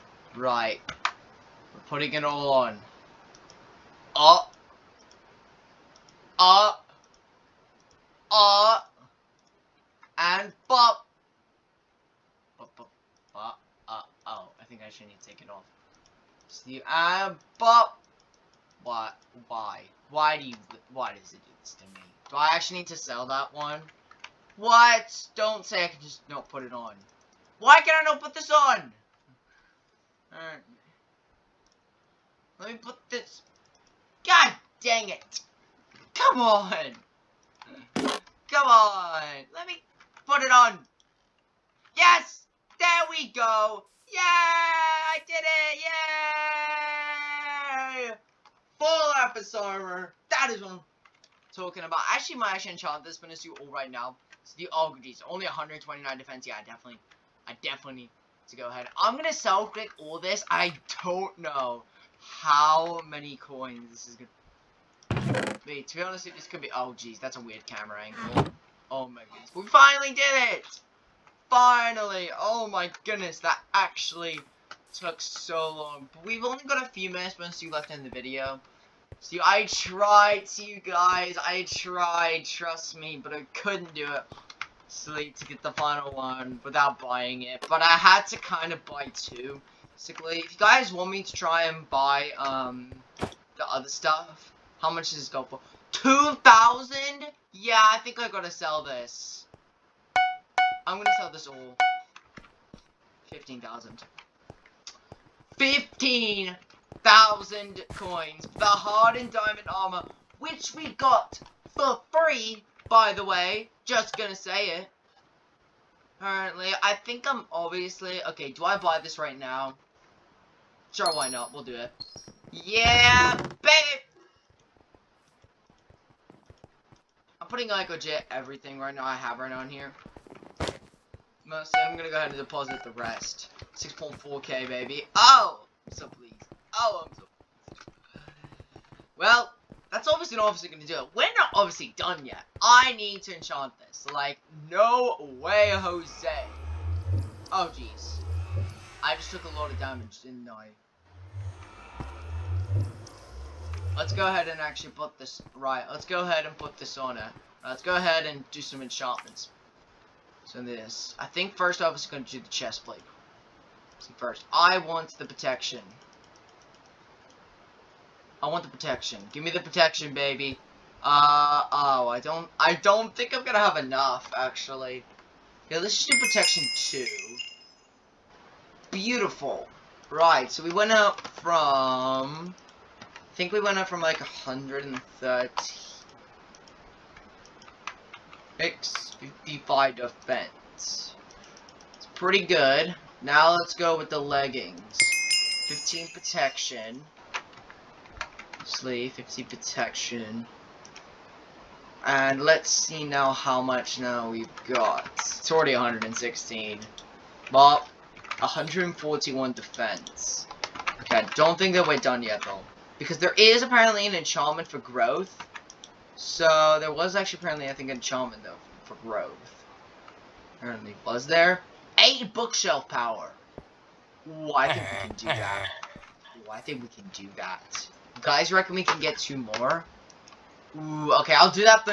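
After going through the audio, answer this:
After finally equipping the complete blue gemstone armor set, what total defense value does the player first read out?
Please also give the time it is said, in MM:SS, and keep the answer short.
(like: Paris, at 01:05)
129, at 00:55.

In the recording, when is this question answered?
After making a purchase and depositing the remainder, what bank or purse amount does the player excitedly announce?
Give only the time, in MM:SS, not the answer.
02:13.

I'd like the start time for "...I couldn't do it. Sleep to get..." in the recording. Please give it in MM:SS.
01:23.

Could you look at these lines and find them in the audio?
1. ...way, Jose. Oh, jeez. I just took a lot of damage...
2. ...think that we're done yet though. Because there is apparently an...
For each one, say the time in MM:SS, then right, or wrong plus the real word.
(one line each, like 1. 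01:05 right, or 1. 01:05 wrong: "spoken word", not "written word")
1. 02:25 right
2. 03:31 right.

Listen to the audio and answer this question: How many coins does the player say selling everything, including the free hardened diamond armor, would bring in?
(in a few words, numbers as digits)
15,000.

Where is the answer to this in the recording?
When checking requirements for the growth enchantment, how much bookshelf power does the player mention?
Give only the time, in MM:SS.
03:41.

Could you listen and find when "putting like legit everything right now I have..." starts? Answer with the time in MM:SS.
02:07.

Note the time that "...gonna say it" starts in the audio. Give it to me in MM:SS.
01:54.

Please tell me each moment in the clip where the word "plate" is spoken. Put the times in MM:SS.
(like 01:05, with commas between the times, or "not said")
02:42.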